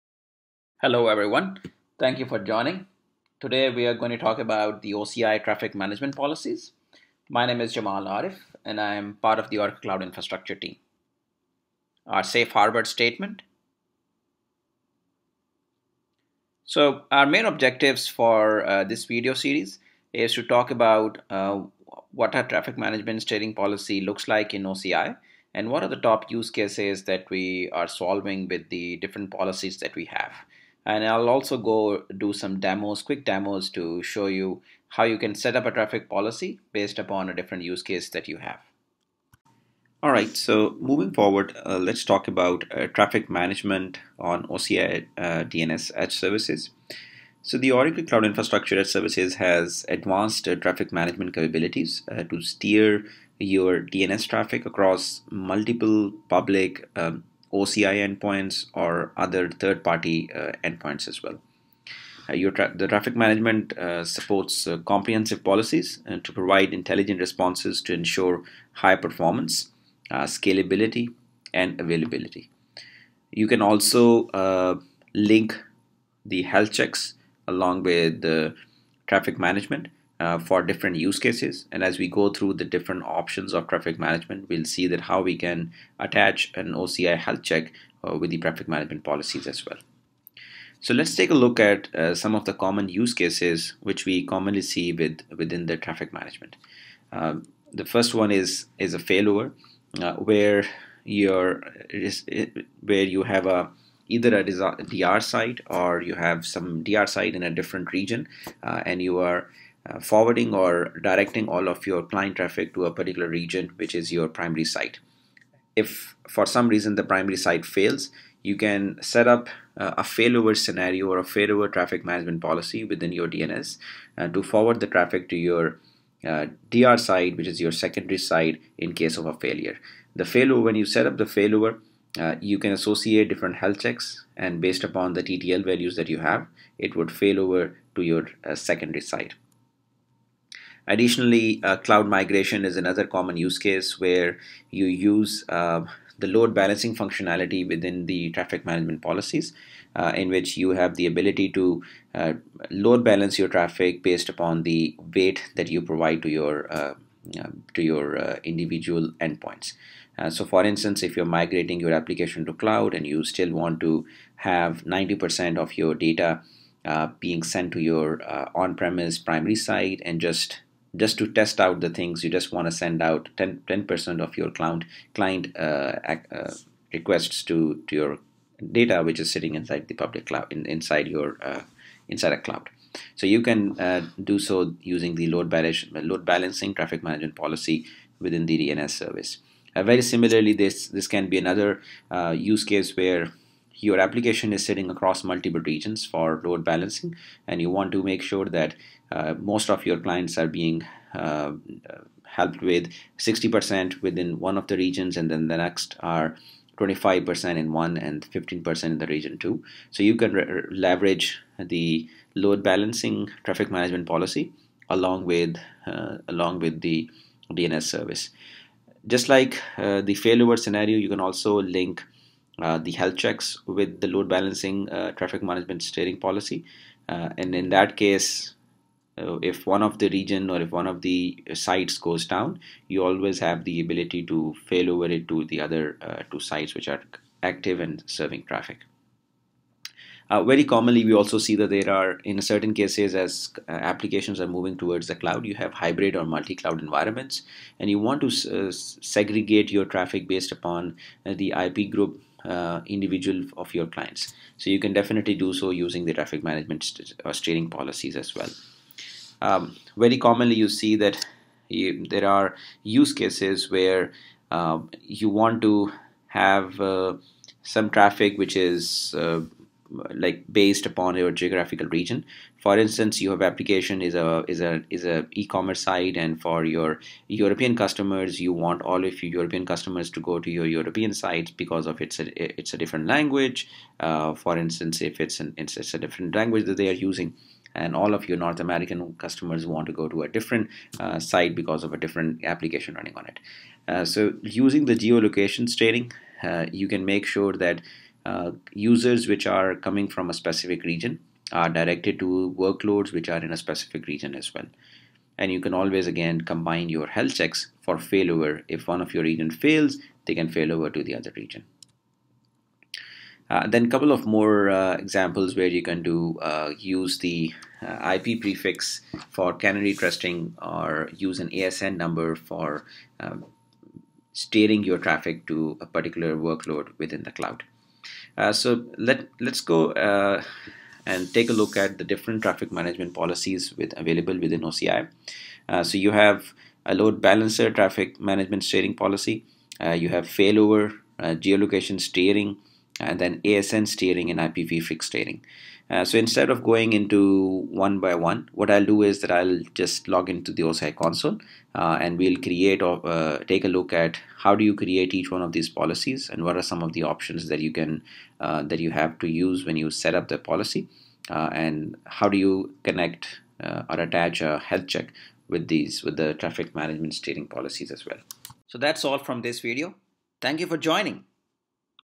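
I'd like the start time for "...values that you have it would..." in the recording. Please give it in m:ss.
2:15.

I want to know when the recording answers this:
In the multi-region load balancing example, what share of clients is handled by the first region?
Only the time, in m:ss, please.
3:23.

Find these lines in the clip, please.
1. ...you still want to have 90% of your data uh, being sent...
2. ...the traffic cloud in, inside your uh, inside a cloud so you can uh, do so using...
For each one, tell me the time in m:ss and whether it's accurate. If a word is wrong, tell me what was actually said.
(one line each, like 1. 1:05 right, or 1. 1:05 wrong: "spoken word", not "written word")
1. 2:43 right
2. 2:59 wrong: "public", not "traffic".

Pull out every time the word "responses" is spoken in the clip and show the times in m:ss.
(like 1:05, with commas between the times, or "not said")
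1:07.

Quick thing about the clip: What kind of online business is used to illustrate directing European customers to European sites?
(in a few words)
e-commerce site.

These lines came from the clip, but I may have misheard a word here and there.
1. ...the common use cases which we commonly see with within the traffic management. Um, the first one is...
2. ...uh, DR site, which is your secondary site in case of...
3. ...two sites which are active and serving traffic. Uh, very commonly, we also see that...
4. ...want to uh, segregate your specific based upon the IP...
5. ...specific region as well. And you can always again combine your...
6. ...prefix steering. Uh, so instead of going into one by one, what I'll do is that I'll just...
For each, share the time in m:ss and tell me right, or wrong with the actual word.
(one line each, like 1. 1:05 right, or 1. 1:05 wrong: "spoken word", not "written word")
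1. 1:32 right
2. 2:06 right
3. 3:56 right
4. 4:07 wrong: "traffic", not "specific"
5. 5:03 right
6. 5:44 right.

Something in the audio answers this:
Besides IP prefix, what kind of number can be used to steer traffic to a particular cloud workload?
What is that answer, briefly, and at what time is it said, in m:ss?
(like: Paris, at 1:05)
ASN number, at 5:21.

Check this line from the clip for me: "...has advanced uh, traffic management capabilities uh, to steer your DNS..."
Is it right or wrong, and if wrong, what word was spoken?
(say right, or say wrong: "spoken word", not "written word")
right.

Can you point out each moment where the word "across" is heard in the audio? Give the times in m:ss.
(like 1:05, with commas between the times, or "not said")
0:54, 3:14.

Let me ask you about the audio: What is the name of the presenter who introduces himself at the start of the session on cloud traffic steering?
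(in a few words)
Jamal Arif.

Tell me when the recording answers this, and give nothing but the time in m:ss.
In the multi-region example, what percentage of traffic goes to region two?
3:28.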